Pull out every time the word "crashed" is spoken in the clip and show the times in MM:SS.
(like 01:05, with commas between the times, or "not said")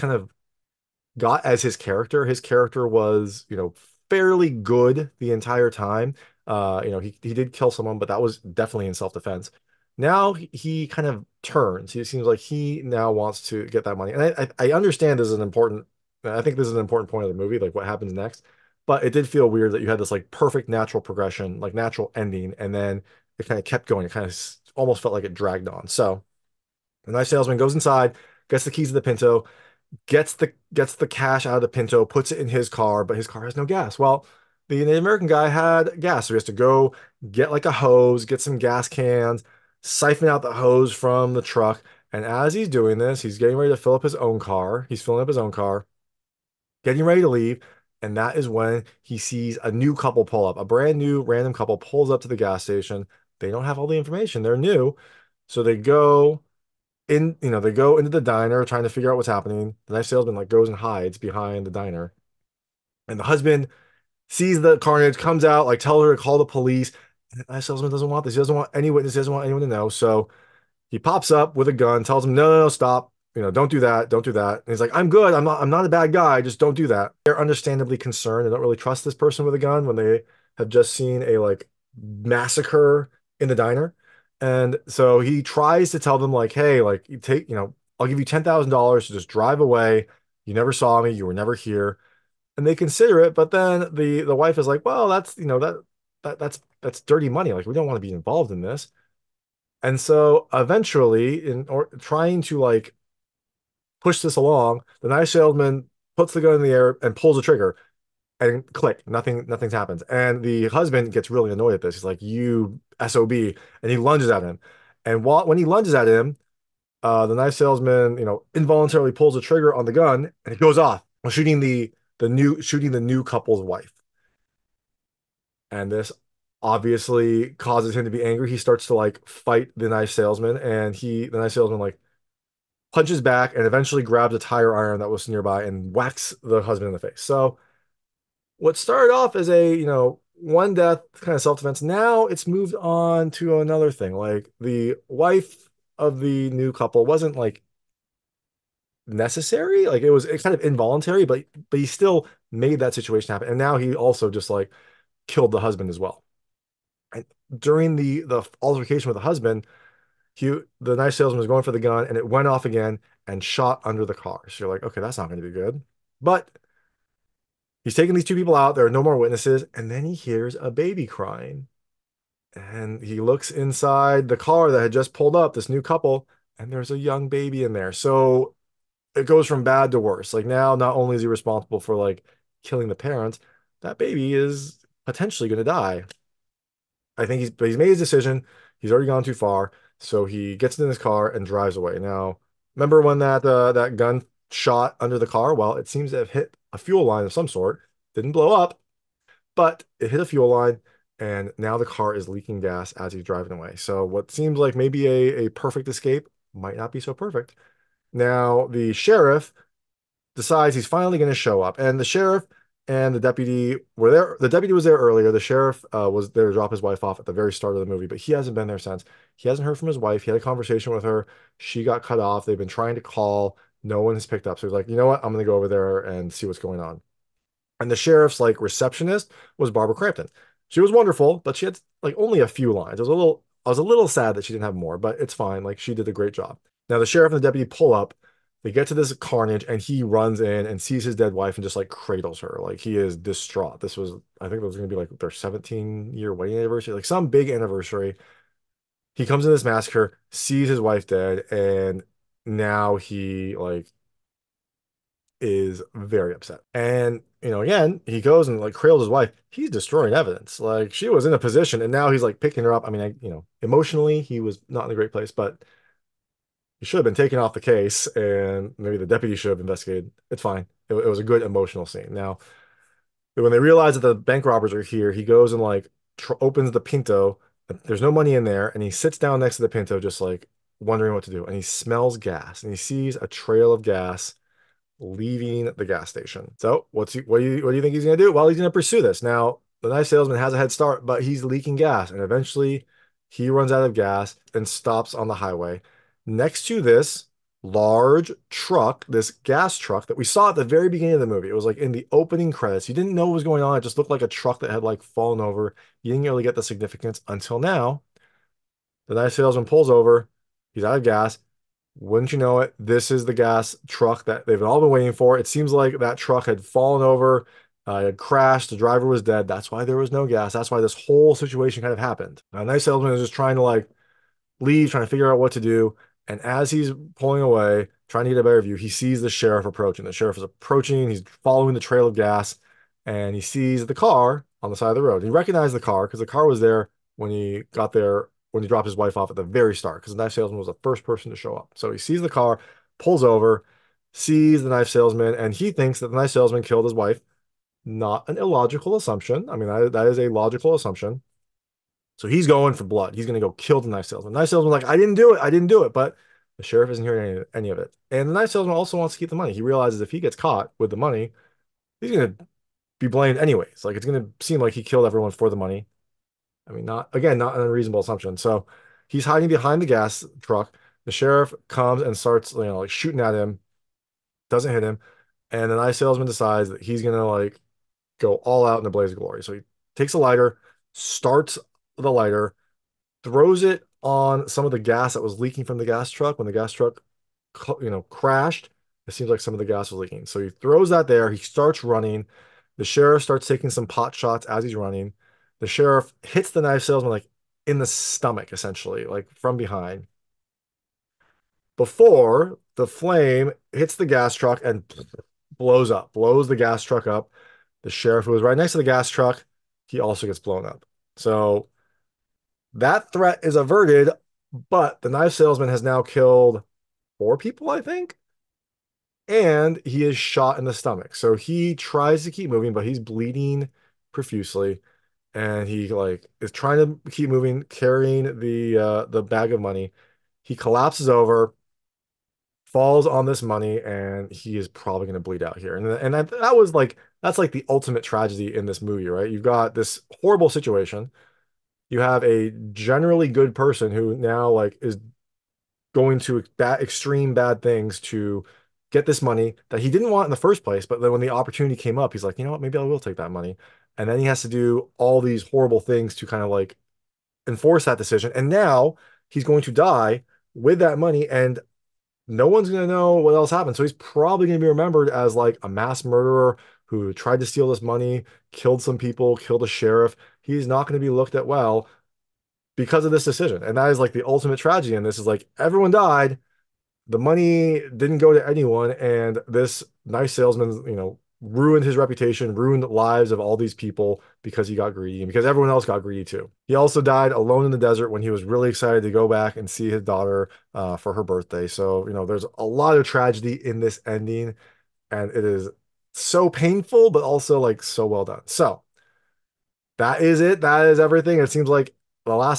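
05:18, 06:28.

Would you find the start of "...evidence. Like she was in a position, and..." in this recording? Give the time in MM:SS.
04:20.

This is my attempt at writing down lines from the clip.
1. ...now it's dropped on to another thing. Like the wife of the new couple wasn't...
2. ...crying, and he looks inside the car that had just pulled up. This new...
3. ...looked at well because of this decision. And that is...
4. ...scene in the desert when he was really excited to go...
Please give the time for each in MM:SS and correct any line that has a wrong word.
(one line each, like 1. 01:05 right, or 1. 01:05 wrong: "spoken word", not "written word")
1. 02:21 wrong: "moved", not "dropped"
2. 02:51 right
3. 07:51 right
4. 08:07 wrong: "alone", not "scene".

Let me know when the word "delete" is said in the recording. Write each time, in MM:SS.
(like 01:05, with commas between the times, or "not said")
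not said.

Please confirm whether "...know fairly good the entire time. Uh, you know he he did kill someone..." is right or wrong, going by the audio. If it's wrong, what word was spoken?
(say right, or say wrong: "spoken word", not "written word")
right.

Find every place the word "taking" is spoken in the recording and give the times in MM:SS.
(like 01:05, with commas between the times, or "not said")
02:47, 06:33.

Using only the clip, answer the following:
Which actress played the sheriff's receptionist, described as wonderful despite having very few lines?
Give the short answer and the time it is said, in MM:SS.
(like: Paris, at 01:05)
Barbara Crampton, at 03:49.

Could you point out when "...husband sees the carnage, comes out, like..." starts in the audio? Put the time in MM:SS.
01:03.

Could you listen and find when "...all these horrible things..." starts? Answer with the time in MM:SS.
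07:34.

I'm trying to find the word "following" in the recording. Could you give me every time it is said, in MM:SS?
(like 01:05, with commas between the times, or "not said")
05:31.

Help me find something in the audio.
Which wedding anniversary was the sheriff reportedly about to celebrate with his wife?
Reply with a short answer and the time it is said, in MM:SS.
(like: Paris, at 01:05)
17th, at 04:05.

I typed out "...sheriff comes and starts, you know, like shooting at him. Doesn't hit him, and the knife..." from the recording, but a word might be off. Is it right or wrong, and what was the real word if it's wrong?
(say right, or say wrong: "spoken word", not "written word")
right.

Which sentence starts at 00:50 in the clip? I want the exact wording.
A brand new random couple pulls up to the gas station.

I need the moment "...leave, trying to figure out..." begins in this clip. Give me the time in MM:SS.
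05:24.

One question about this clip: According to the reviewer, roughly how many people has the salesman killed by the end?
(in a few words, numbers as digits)
4.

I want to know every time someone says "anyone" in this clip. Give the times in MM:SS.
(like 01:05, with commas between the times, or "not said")
01:09, 07:58.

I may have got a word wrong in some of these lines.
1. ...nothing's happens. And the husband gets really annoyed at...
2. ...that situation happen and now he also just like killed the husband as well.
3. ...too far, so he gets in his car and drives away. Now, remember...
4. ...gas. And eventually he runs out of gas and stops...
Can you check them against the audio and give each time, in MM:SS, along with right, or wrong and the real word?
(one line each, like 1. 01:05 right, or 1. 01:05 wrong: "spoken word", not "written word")
1. 01:49 right
2. 02:32 right
3. 03:09 right
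4. 04:51 right.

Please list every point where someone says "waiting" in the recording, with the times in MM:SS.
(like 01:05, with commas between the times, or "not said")
05:14.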